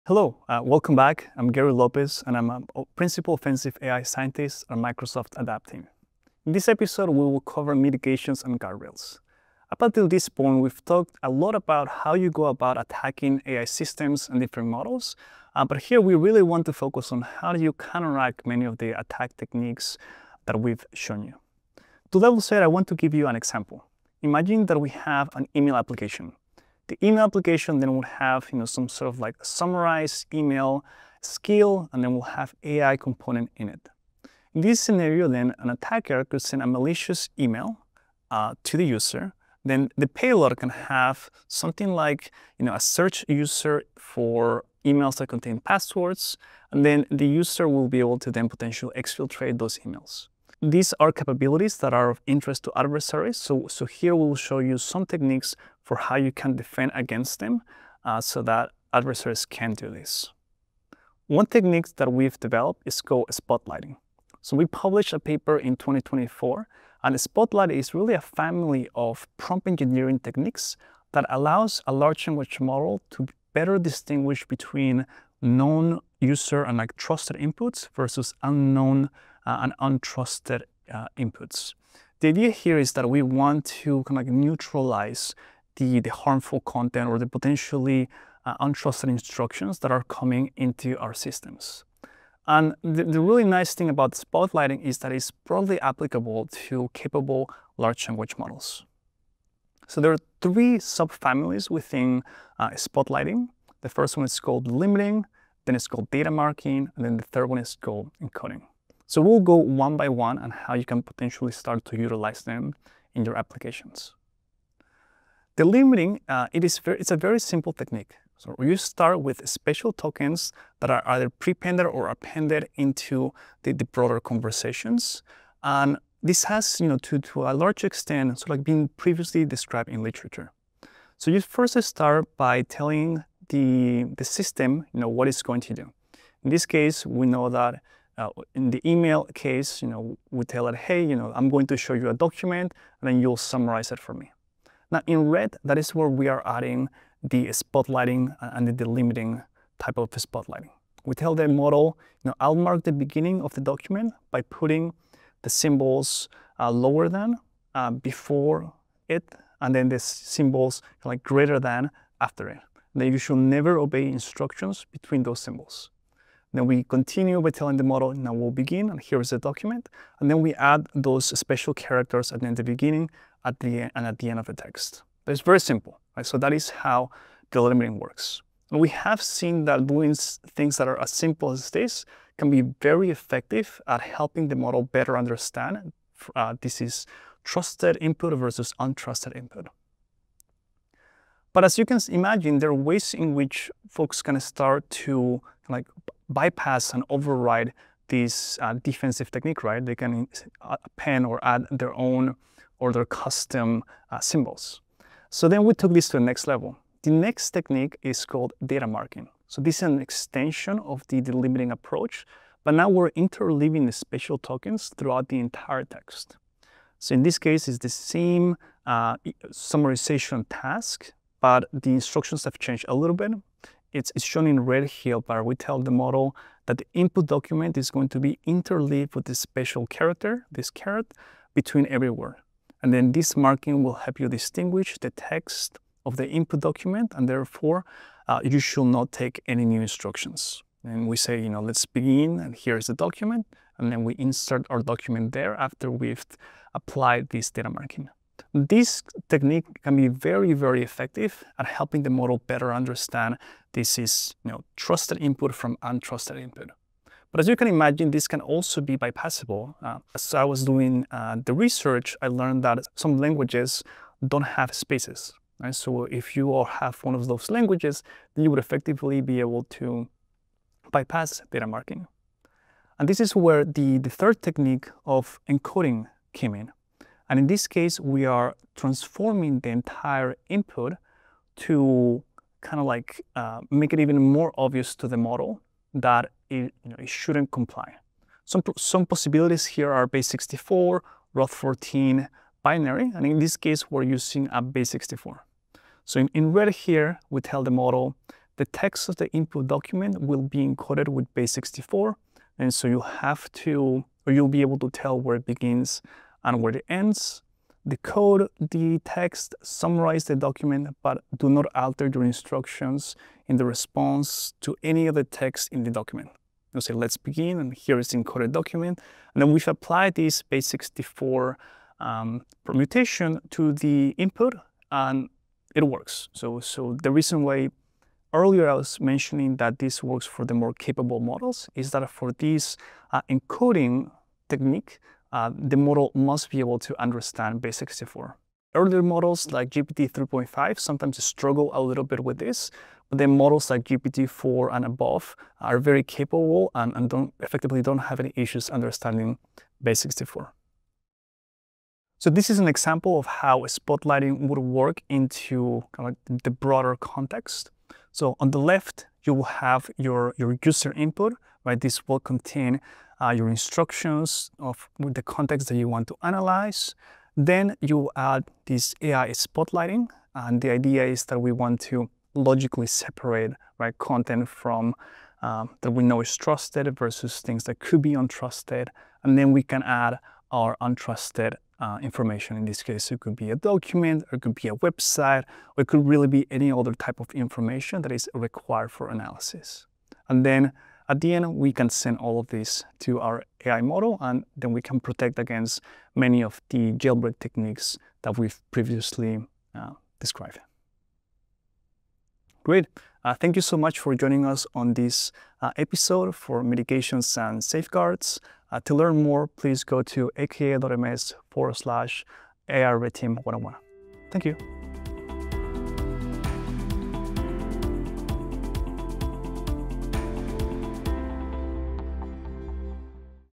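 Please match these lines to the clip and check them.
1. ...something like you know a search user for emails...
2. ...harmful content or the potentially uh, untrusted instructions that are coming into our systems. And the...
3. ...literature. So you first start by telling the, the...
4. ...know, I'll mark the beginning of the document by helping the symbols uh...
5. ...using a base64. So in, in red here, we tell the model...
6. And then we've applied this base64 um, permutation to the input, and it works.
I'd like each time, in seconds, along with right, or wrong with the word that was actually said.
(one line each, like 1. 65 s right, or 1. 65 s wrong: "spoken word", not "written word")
1. 41 s right
2. 86 s right
3. 130 s right
4. 152 s wrong: "putting", not "helping"
5. 294 s right
6. 319 s right.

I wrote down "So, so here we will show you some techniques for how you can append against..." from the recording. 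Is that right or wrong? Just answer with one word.
wrong.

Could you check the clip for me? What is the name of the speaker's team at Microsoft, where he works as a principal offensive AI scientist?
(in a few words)
ADAPT.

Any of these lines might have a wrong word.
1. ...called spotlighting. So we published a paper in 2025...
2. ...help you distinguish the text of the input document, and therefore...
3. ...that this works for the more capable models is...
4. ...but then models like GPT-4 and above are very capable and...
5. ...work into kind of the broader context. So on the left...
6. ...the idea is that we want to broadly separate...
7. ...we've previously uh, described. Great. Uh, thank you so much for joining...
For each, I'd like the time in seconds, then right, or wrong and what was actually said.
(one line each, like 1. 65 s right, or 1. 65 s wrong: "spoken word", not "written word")
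1. 63 s wrong: "2024", not "2025"
2. 233 s right
3. 329 s right
4. 343 s right
5. 354 s right
6. 370 s wrong: "logically", not "broadly"
7. 398 s right.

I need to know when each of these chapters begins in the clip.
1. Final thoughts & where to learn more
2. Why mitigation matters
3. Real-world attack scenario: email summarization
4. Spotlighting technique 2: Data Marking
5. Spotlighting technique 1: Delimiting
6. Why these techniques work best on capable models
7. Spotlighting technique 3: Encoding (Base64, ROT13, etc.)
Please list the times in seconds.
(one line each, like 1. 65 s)
1. 400 s
2. 20 s
3. 60 s
4. 191 s
5. 115 s
6. 356 s
7. 273 s.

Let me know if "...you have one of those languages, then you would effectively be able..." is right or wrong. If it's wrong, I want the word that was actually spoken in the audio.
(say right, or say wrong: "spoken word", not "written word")
right.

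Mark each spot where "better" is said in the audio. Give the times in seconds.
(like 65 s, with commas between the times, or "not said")
73 s, 184 s, 252 s.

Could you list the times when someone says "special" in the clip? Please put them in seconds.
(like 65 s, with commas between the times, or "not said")
119 s, 171 s, 229 s.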